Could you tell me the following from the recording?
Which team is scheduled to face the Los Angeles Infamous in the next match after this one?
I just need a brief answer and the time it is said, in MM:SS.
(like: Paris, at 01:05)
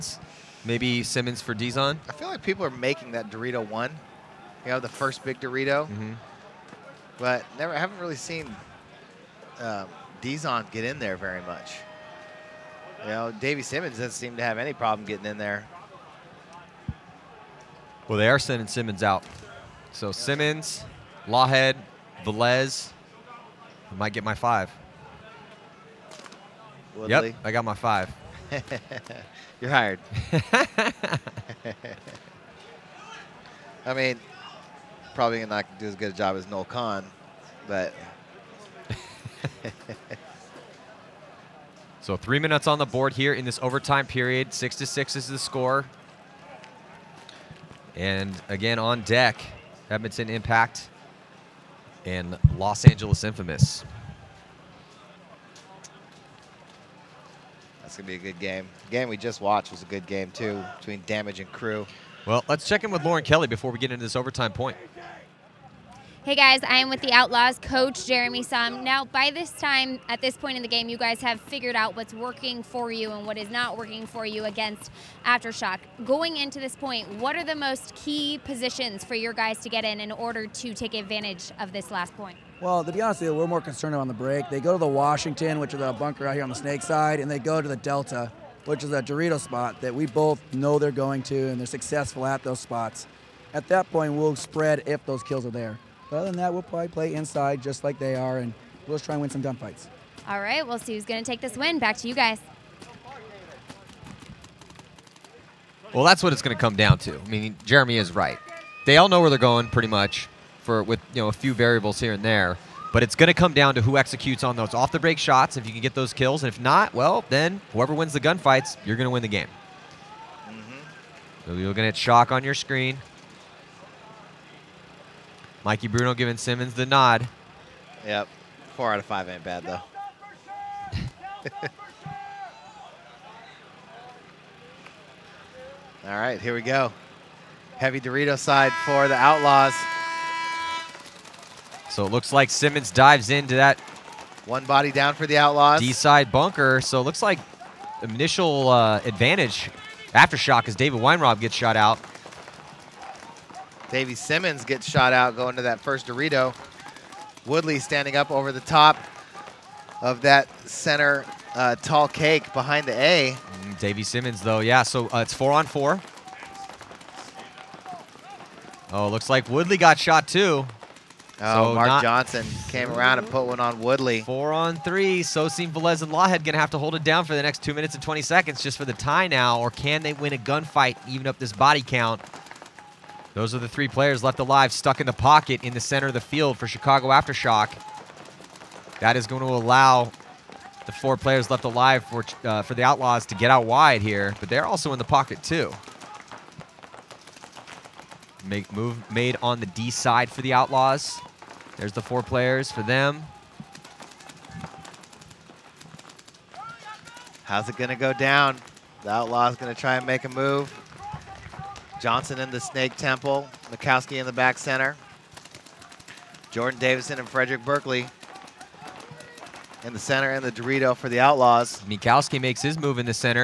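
Edmonton Impact, at 00:49.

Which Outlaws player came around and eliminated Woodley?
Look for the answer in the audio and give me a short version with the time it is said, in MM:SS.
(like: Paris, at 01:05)
Mark Johnson, at 02:51.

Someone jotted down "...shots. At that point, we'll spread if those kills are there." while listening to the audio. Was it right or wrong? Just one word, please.
wrong.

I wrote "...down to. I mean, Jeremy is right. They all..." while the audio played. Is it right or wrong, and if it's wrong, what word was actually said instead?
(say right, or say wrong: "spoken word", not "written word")
right.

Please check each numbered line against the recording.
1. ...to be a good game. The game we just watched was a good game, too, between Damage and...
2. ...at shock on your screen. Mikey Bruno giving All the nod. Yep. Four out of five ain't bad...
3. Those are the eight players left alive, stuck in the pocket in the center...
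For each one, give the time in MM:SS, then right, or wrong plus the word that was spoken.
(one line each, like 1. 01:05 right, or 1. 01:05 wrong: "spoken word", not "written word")
1. 00:58 right
2. 02:01 wrong: "Simmons", not "All"
3. 03:03 wrong: "three", not "eight".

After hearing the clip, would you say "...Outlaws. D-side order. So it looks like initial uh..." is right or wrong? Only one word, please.
wrong.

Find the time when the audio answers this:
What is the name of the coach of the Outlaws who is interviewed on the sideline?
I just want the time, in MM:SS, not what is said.
01:08.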